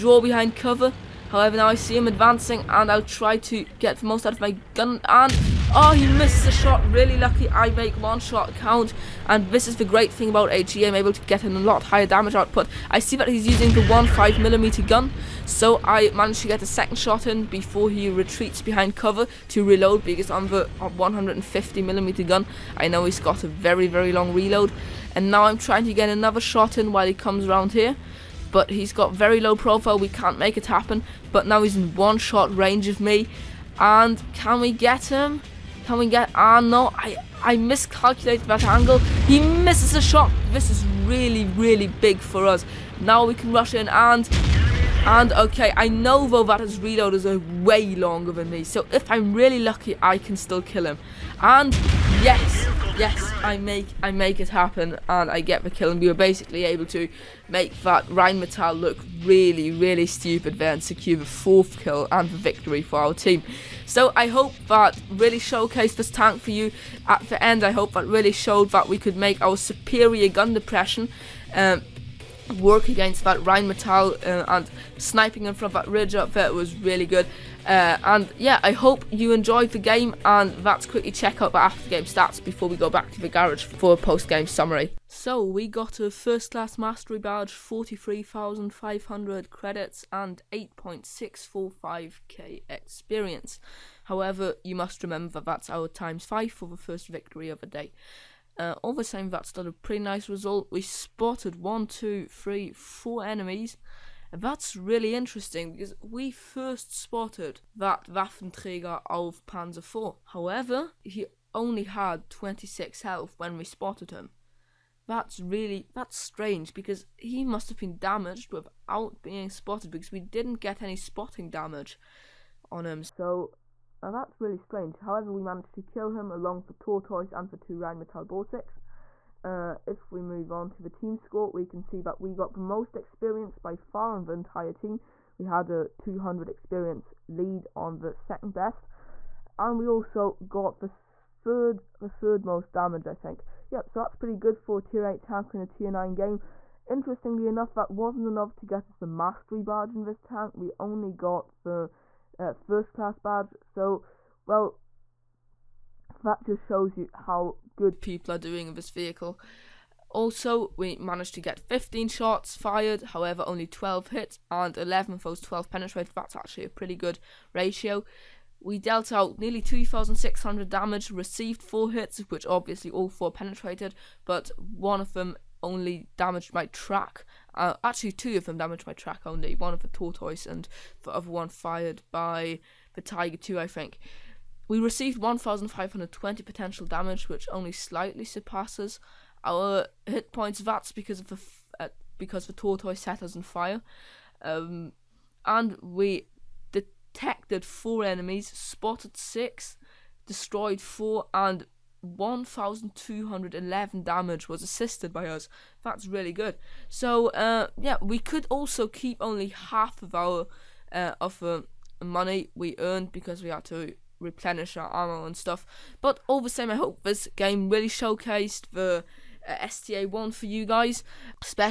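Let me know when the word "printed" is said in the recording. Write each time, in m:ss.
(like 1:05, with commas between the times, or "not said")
not said.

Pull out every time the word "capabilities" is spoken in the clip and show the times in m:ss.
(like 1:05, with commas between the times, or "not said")
not said.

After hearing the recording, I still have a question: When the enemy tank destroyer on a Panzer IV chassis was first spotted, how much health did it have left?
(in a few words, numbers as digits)
26.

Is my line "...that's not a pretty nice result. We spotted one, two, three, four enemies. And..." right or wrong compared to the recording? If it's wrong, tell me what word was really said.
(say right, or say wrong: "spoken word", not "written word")
right.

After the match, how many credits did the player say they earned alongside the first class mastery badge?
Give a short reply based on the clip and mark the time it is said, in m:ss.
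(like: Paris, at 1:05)
43,500, at 1:27.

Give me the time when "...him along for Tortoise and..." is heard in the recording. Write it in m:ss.
2:06.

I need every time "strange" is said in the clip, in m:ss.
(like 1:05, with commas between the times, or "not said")
1:56, 2:04.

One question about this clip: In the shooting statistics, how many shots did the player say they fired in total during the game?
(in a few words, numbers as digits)
15.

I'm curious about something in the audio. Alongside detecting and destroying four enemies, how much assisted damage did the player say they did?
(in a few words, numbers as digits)
1211.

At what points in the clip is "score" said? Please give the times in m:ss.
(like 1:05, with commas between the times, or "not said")
2:11.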